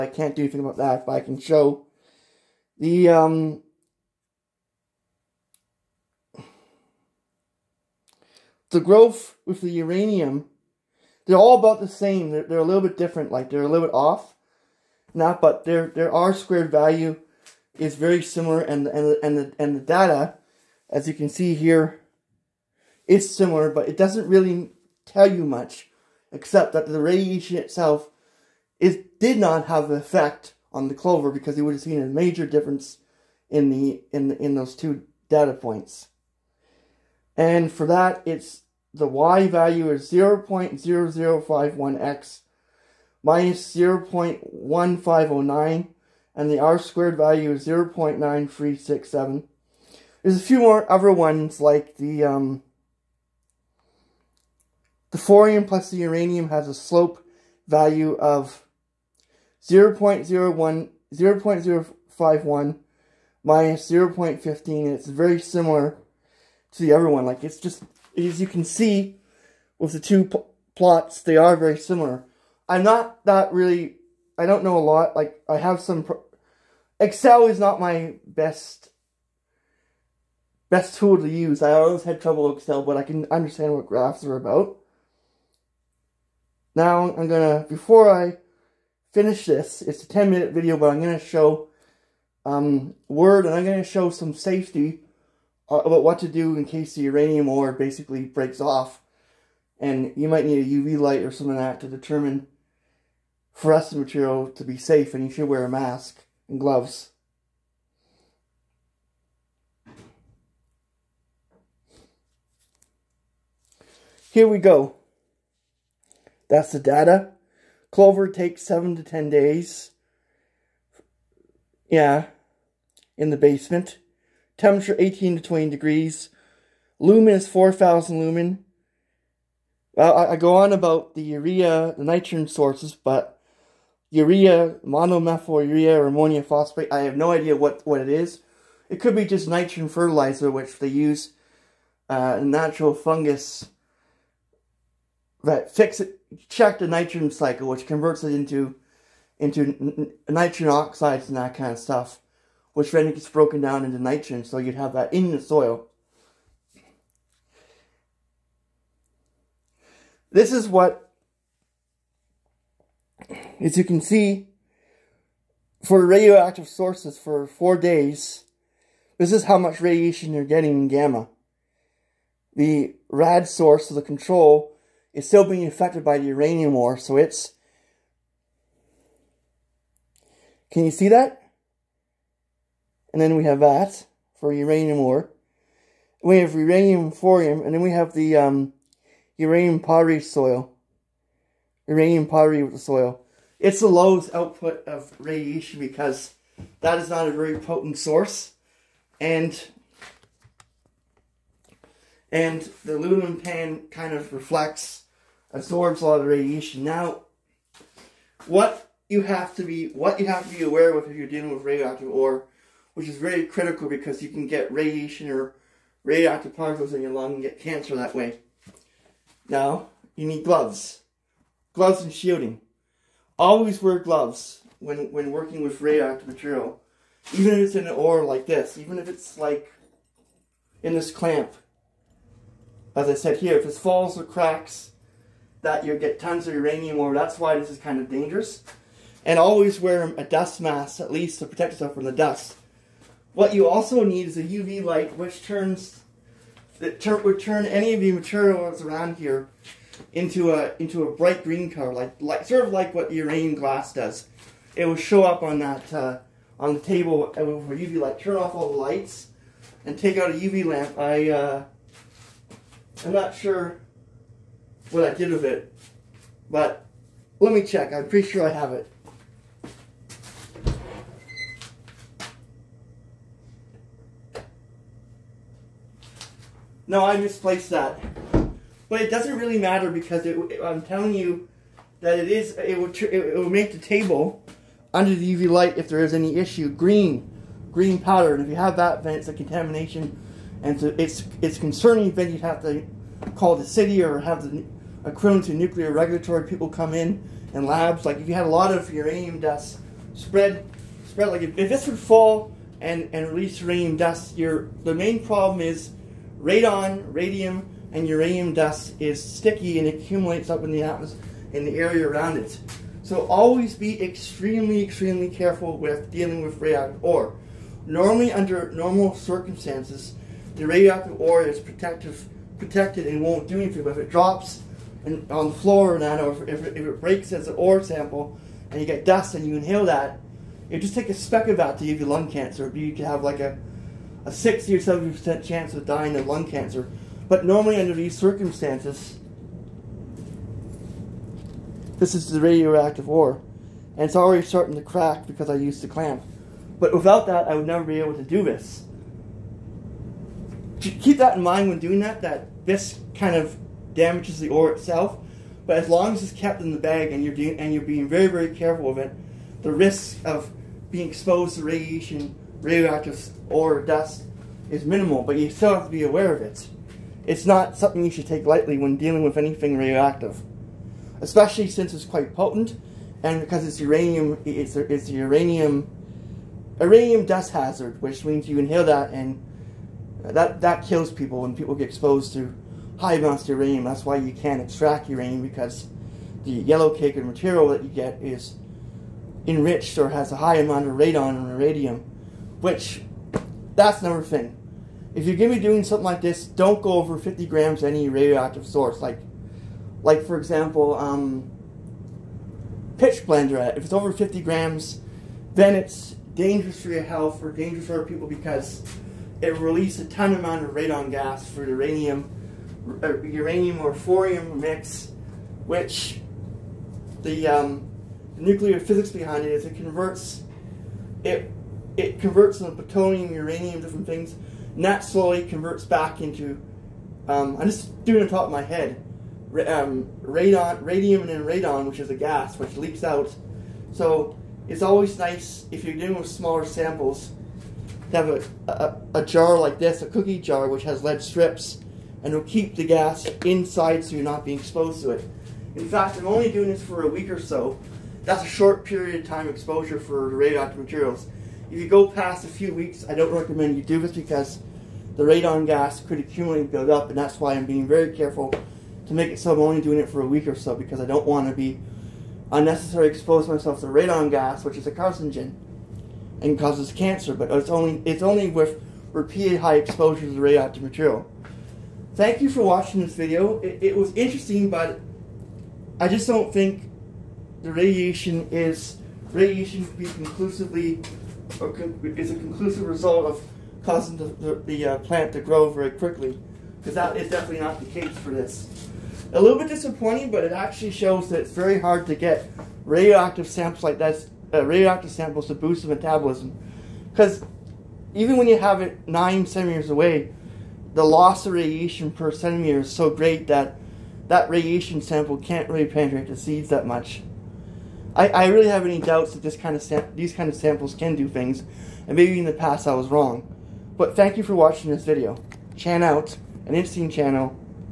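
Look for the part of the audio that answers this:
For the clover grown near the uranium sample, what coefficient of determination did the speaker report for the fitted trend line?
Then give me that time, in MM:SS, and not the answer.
00:47.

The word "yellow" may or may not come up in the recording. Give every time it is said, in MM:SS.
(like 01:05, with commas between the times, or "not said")
06:26.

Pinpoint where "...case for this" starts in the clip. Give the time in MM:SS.
08:07.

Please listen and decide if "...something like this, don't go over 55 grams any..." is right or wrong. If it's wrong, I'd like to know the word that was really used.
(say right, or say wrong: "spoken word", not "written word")
wrong: "50", not "55".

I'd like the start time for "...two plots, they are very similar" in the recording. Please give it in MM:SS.
01:09.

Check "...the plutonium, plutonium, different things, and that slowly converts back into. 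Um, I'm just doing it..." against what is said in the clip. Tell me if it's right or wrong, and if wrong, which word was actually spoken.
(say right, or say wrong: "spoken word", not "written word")
wrong: "uranium", not "plutonium".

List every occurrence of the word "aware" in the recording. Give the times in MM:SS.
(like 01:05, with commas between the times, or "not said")
03:30, 06:06.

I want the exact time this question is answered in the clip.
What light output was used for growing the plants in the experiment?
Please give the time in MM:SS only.
02:07.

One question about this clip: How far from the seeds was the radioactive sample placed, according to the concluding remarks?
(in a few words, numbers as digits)
9 centimeters.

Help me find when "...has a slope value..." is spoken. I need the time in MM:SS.
00:56.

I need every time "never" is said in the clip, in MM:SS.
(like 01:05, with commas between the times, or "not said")
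05:47.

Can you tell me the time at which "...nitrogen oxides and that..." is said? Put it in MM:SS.
02:30.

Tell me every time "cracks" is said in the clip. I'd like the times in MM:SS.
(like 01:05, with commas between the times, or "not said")
03:54, 05:44.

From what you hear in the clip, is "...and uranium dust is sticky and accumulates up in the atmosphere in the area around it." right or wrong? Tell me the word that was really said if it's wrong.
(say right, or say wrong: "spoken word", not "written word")
right.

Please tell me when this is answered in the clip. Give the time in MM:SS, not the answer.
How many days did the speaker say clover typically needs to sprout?
01:58.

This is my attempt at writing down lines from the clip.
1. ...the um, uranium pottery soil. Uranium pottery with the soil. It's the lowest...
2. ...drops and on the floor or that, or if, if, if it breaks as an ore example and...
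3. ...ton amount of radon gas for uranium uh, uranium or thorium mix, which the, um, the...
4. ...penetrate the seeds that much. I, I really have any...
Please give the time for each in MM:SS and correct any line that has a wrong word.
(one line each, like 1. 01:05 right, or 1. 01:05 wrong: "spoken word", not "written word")
1. 03:08 right
2. 05:24 wrong: "sample", not "example"
3. 06:50 right
4. 08:25 right.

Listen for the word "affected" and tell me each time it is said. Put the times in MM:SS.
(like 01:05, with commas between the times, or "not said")
02:55.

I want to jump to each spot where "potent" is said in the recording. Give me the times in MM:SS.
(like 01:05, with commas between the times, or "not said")
03:17, 06:12.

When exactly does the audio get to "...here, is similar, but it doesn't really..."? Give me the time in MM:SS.
00:21.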